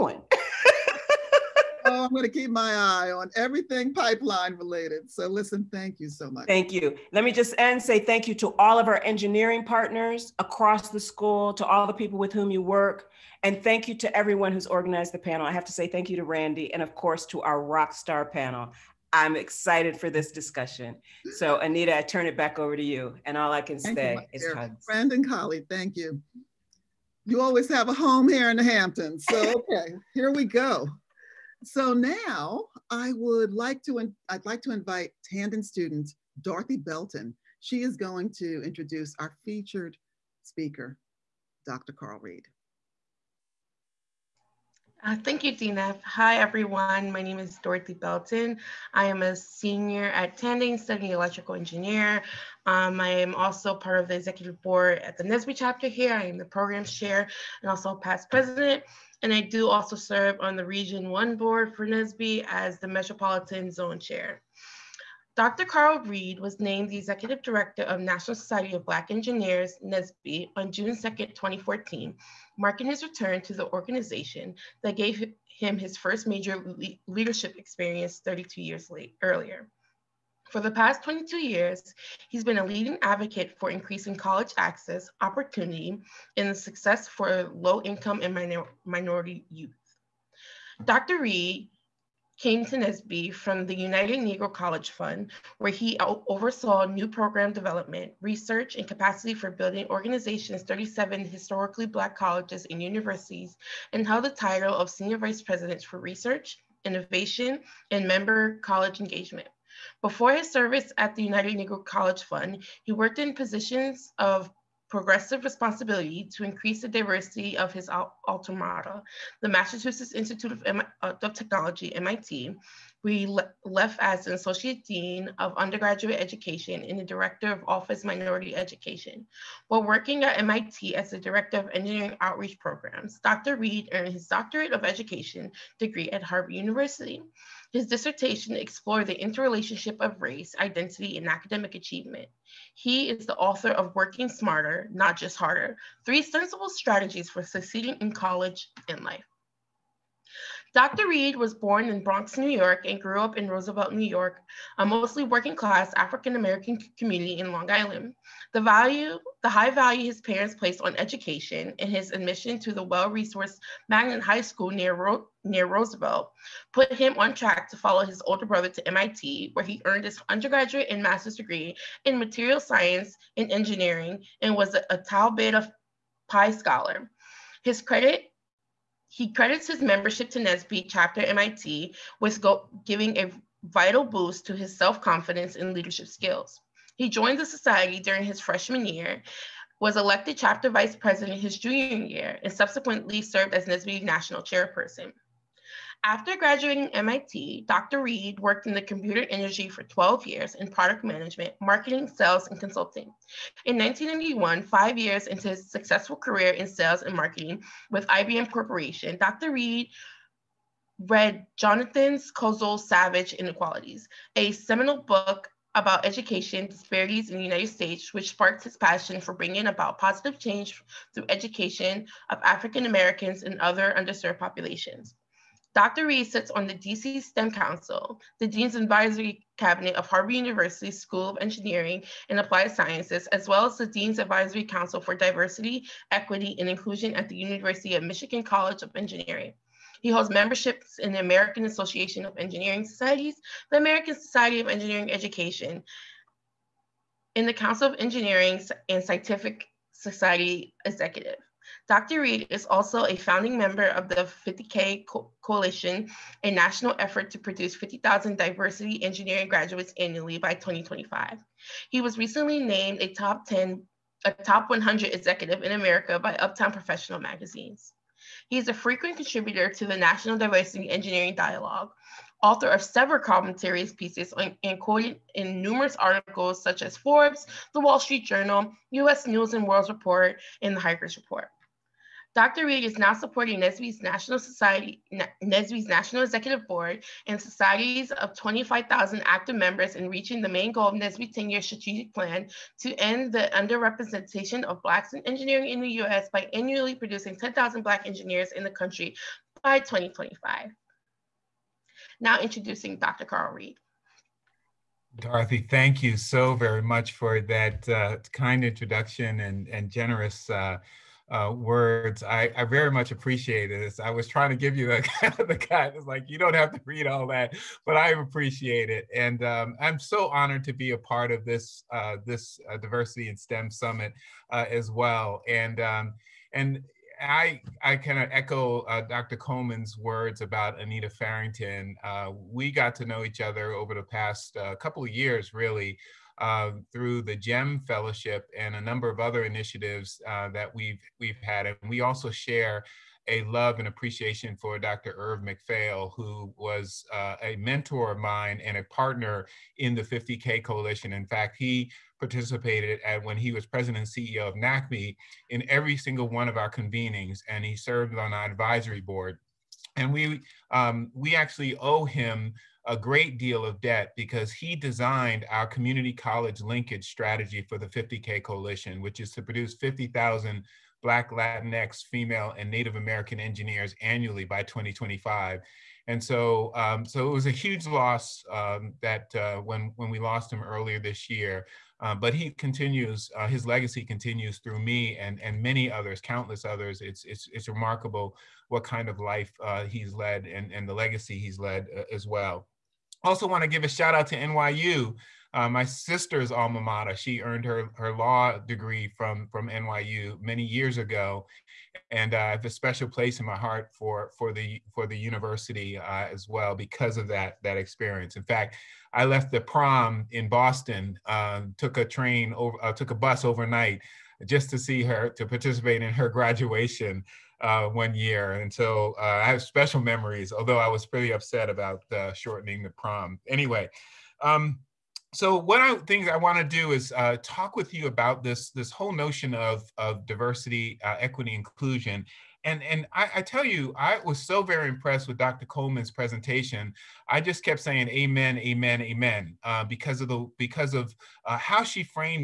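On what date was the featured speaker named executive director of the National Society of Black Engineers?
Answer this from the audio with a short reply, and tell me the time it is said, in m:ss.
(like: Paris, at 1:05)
June 2, 2014, at 1:10.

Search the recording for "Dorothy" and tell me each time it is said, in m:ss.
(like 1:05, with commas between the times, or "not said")
0:36, 0:47, 5:05.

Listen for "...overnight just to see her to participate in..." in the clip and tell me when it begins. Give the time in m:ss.
6:53.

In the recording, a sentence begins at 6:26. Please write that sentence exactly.
It's, it's, it's remarkable what kind of life uh, he's led and, and the legacy he's led uh, as well.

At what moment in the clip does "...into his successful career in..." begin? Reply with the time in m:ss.
3:25.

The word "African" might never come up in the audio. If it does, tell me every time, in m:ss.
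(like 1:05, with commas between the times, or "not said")
2:35, 3:42.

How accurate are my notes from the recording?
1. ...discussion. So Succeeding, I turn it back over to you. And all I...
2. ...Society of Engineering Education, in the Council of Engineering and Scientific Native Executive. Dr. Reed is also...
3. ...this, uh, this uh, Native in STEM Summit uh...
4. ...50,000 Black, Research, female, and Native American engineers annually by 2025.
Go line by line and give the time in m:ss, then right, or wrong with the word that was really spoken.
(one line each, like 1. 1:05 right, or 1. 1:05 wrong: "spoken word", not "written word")
1. 0:20 wrong: "Anita", not "Succeeding"
2. 4:04 wrong: "Society", not "Native"
3. 5:21 wrong: "Diversity", not "Native"
4. 6:09 wrong: "Latinx", not "Research".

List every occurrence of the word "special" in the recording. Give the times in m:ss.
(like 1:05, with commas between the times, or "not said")
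6:42, 6:59.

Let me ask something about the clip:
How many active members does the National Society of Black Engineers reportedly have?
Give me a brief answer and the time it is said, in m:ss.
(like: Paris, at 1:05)
25,000, at 4:48.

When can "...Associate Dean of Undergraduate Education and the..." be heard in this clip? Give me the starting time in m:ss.
2:04.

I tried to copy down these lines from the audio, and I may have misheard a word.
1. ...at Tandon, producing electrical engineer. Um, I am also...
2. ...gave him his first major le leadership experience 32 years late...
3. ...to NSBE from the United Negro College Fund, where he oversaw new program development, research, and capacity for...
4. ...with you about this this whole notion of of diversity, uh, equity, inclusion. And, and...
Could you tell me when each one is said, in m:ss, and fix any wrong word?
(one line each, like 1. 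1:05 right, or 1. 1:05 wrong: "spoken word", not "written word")
1. 0:50 wrong: "studying", not "producing"
2. 1:14 right
3. 1:32 right
4. 7:07 right.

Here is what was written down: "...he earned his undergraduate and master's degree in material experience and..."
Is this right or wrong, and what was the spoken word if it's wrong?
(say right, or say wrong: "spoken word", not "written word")
wrong: "science", not "experience".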